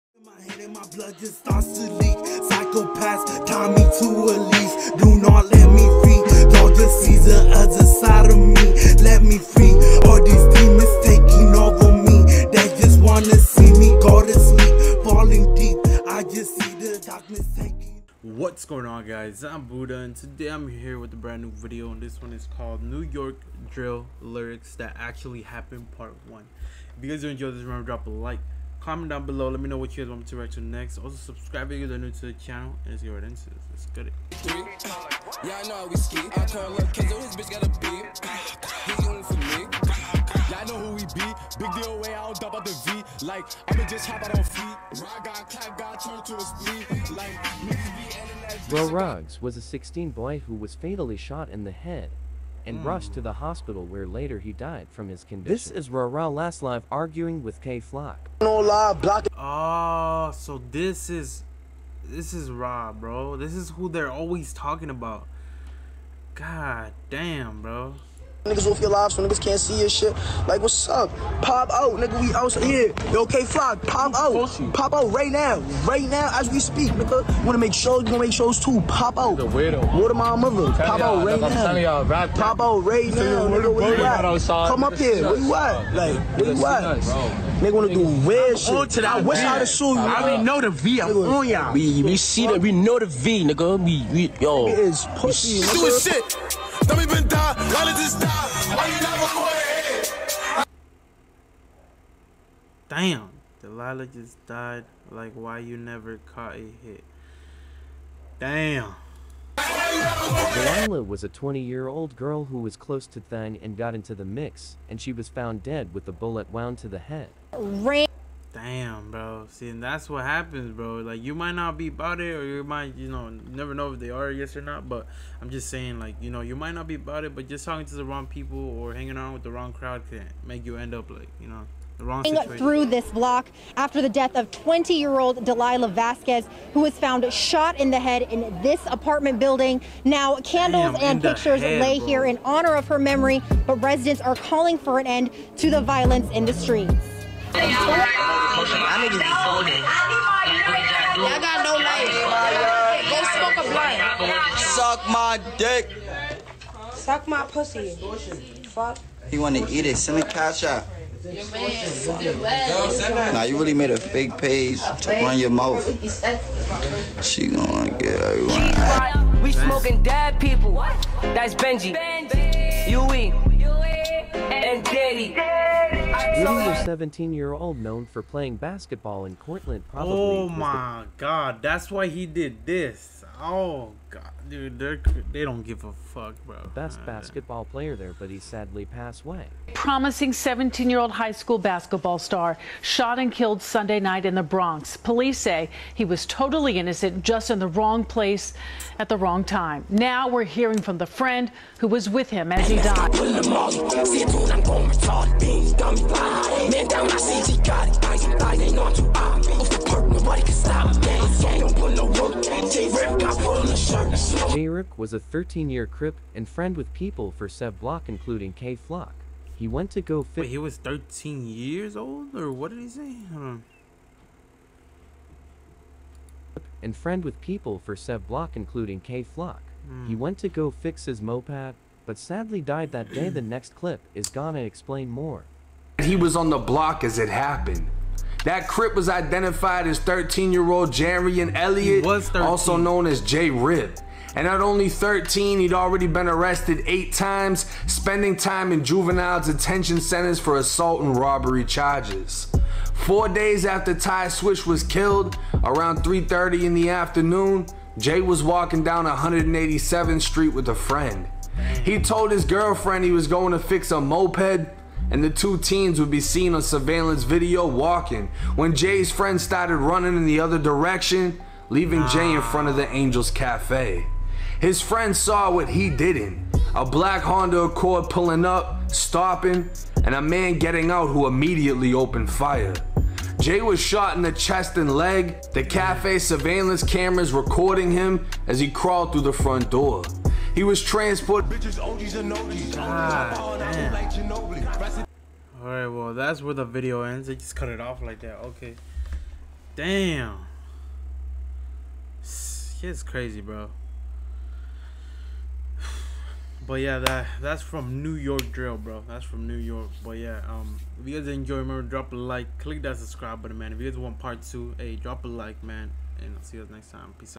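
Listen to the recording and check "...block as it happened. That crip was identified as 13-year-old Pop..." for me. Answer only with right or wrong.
wrong.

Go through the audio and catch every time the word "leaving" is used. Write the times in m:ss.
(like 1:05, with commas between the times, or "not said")
4:31.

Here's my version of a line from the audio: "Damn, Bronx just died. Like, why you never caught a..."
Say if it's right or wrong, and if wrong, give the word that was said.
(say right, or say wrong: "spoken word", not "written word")
wrong: "Delilah", not "Bronx".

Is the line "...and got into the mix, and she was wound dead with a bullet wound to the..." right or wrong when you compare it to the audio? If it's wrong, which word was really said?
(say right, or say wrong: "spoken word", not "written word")
wrong: "found", not "wound".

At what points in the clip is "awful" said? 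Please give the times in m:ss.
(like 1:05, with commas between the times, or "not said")
not said.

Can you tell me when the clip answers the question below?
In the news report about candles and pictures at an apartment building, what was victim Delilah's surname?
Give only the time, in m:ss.
2:15.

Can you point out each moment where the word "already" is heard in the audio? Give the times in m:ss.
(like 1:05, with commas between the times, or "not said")
1:30, 4:05.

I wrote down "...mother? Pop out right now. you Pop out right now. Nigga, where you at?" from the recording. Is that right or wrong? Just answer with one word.
right.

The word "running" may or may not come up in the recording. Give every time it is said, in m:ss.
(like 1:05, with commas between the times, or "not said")
4:29.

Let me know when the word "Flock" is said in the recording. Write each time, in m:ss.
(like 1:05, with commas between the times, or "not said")
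0:57, 1:13, 3:38, 3:49.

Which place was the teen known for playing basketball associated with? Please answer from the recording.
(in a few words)
Cortland.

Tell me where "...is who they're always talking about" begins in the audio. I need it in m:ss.
1:03.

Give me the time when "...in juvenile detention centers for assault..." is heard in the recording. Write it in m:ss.
4:08.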